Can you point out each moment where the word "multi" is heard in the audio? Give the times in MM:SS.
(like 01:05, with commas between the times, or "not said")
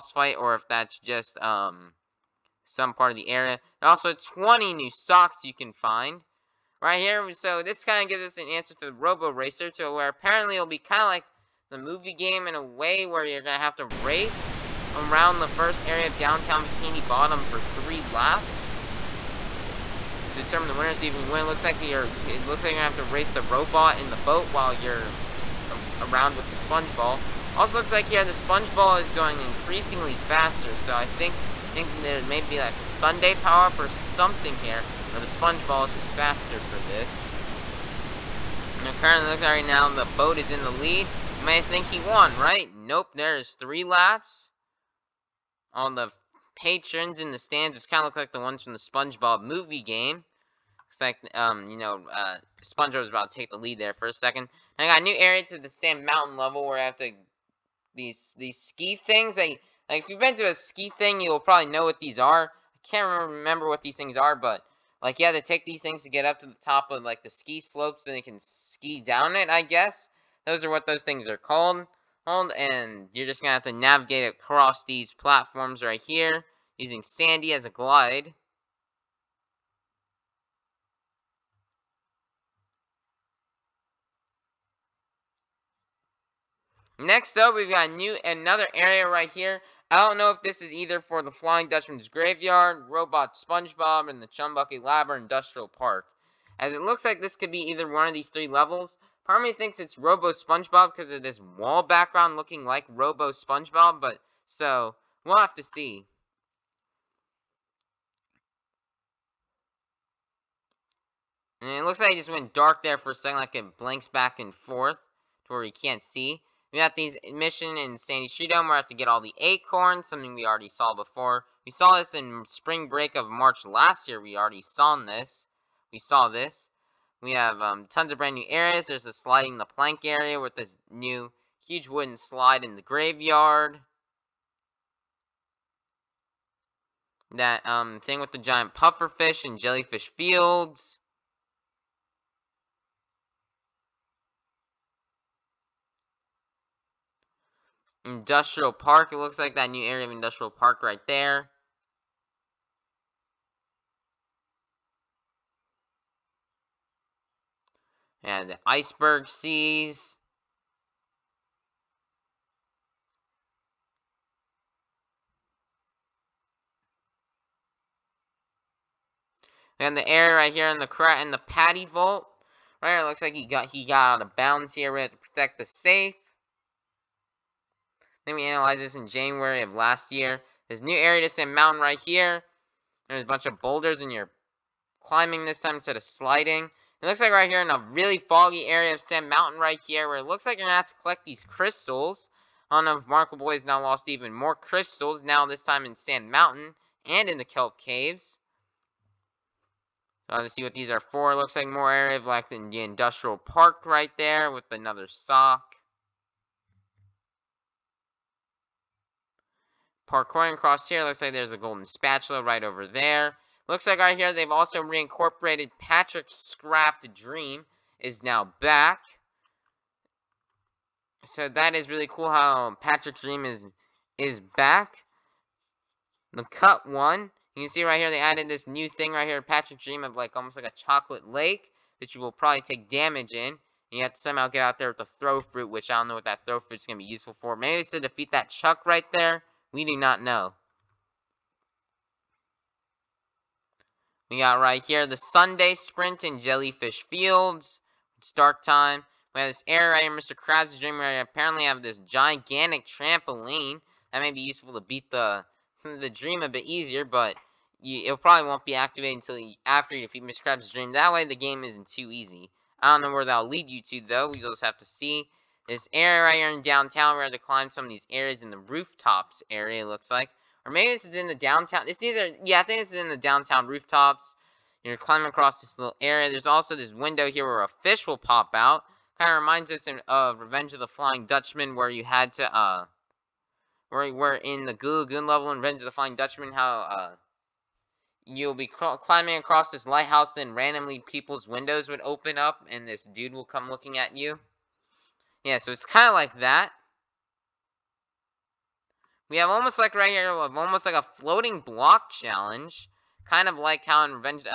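not said.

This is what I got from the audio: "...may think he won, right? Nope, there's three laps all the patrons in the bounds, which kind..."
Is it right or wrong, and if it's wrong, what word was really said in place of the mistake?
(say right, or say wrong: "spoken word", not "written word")
wrong: "stands", not "bounds".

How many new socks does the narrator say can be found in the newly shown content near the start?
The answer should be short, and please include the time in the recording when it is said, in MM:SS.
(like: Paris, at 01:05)
20, at 00:04.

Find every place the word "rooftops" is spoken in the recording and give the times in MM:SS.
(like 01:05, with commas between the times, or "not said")
04:28, 04:33.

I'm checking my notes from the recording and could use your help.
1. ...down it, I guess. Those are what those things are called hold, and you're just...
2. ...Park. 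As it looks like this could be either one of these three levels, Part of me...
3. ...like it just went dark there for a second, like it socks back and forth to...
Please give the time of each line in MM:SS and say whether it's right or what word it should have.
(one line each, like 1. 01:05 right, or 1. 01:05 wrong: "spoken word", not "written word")
1. 01:08 right
2. 01:35 right
3. 01:51 wrong: "blinks", not "socks".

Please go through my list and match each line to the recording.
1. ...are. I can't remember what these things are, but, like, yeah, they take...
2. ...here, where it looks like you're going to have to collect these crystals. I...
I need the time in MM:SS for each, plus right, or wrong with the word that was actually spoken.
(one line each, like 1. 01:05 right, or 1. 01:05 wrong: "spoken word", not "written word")
1. 01:02 right
2. 03:09 right.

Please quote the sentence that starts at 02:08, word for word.
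There's the sliding the plank area with this new huge wooden slide in the graveyard.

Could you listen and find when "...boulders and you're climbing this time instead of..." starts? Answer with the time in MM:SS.
03:03.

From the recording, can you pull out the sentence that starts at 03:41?
So that is really cool how Patrick Dream is is back.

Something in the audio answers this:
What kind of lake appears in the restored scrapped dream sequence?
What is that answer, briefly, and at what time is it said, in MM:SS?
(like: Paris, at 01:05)
chocolate lake, at 03:50.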